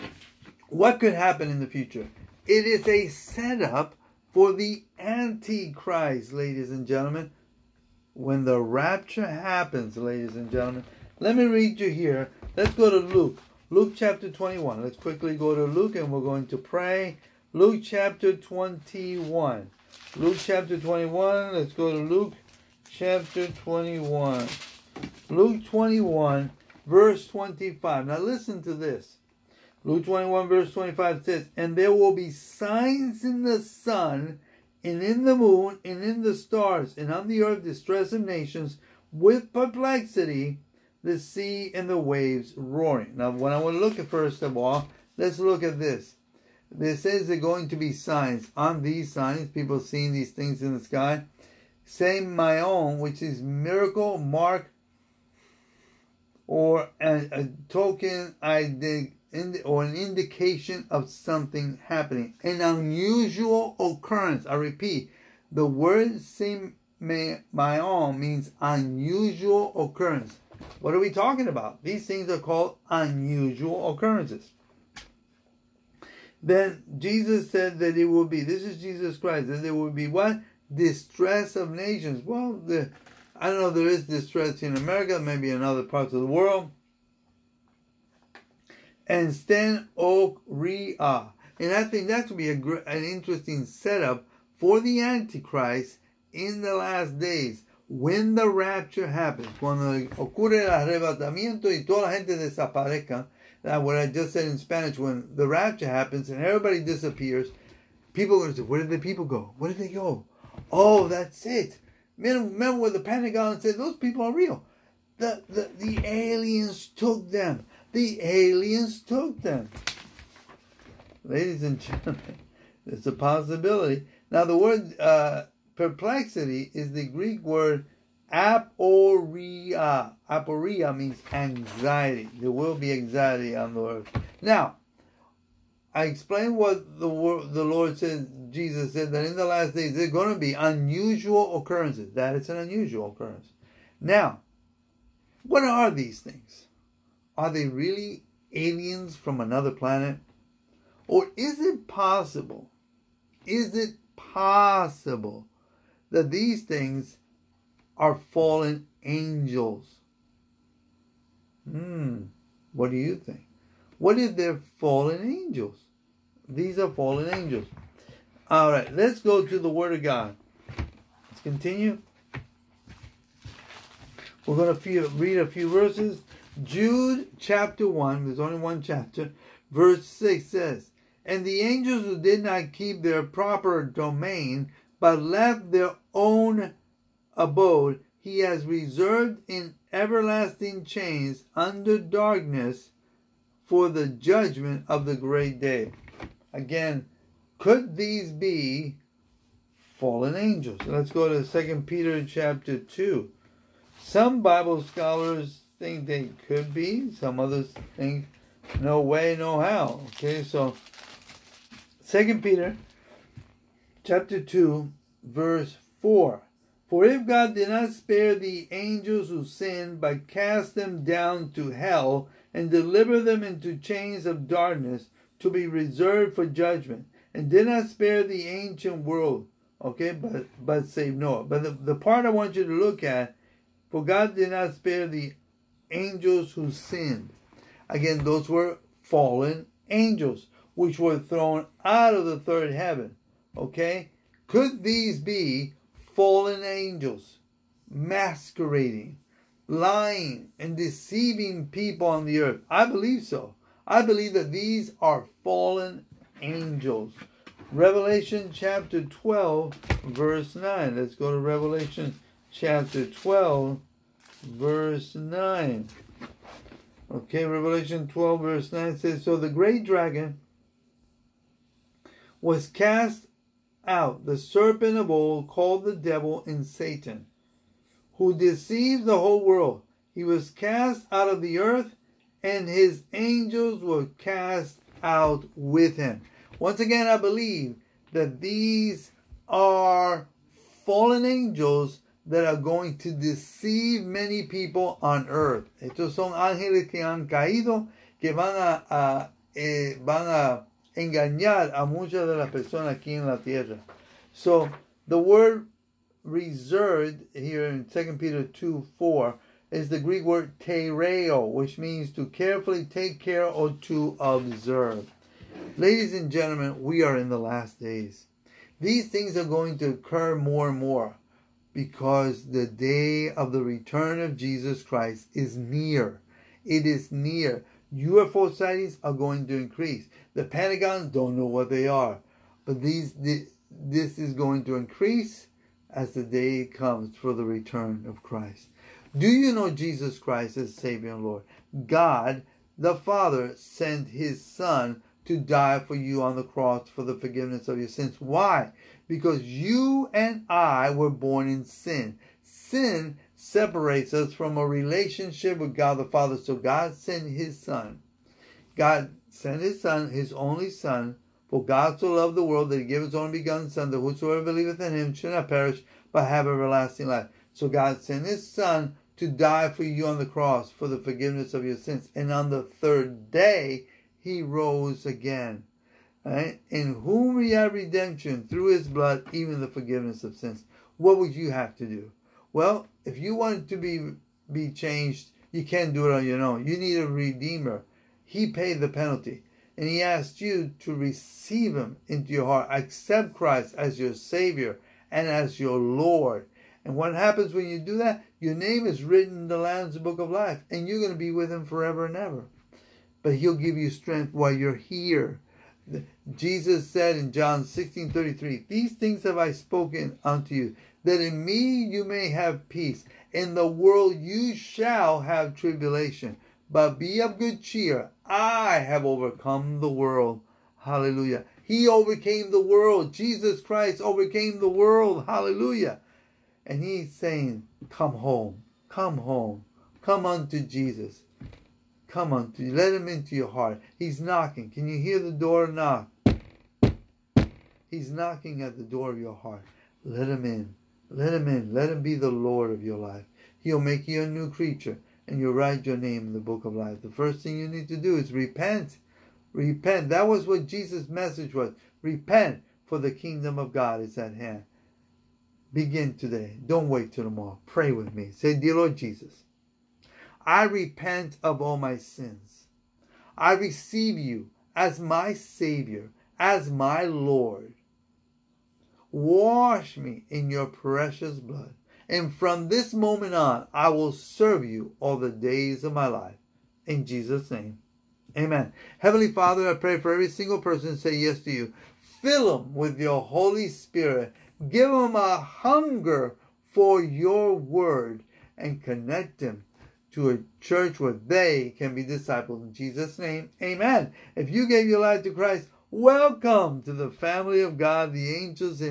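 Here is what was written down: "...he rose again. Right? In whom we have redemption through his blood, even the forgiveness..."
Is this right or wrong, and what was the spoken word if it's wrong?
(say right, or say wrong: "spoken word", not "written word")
right.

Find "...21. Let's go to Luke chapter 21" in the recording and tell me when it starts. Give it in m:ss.
0:20.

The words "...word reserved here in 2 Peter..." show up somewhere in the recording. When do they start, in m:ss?
5:05.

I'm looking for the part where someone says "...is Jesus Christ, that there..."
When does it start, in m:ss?
1:18.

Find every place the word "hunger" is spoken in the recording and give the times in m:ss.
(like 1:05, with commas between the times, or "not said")
8:05.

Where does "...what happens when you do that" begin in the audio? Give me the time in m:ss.
6:36.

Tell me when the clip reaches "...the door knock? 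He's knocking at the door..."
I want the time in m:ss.
7:15.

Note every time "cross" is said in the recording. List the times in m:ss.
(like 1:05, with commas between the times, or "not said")
5:46, 6:10.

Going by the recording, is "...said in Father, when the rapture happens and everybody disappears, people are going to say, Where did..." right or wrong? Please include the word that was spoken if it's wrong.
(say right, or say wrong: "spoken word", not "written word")
wrong: "Spanish", not "Father".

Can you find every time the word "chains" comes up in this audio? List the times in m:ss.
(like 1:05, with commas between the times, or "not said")
3:10, 3:43.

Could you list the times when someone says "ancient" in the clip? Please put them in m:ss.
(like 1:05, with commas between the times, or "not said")
3:48.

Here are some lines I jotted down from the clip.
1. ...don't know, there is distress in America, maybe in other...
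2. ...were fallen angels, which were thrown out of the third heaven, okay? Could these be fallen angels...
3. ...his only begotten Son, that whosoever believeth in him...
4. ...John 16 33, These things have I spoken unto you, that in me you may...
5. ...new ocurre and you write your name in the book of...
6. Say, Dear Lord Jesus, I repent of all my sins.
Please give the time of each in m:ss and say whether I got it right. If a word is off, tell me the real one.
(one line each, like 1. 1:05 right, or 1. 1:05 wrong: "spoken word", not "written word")
1. 1:23 right
2. 3:58 right
3. 6:03 right
4. 6:47 right
5. 7:24 wrong: "creature", not "ocurre"
6. 7:38 right.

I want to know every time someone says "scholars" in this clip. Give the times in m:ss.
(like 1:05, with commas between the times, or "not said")
3:24.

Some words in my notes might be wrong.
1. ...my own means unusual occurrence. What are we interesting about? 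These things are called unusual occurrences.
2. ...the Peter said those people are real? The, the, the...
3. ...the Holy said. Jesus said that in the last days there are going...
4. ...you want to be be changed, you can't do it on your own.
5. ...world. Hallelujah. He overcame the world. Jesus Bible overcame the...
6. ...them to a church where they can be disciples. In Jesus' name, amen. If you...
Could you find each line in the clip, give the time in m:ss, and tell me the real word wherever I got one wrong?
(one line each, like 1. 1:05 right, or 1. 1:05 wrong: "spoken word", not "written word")
1. 1:07 wrong: "talking", not "interesting"
2. 1:52 wrong: "Pentagon", not "Peter"
3. 2:17 wrong: "Lord", not "Holy"
4. 6:23 right
5. 6:59 wrong: "Christ", not "Bible"
6. 8:09 right.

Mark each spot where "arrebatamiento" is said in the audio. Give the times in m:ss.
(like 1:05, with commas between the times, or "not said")
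1:40.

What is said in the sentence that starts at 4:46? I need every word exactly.
Once again, I believe that these are fallen angels that are going to deceive many people on earth.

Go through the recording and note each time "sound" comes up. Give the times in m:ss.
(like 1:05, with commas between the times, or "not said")
not said.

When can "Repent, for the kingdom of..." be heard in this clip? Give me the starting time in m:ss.
7:32.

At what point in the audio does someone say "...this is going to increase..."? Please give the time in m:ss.
5:33.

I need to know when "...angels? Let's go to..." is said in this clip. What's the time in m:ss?
3:20.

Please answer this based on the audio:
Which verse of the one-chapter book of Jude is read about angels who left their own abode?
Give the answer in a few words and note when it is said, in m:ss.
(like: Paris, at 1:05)
verse 6, at 2:59.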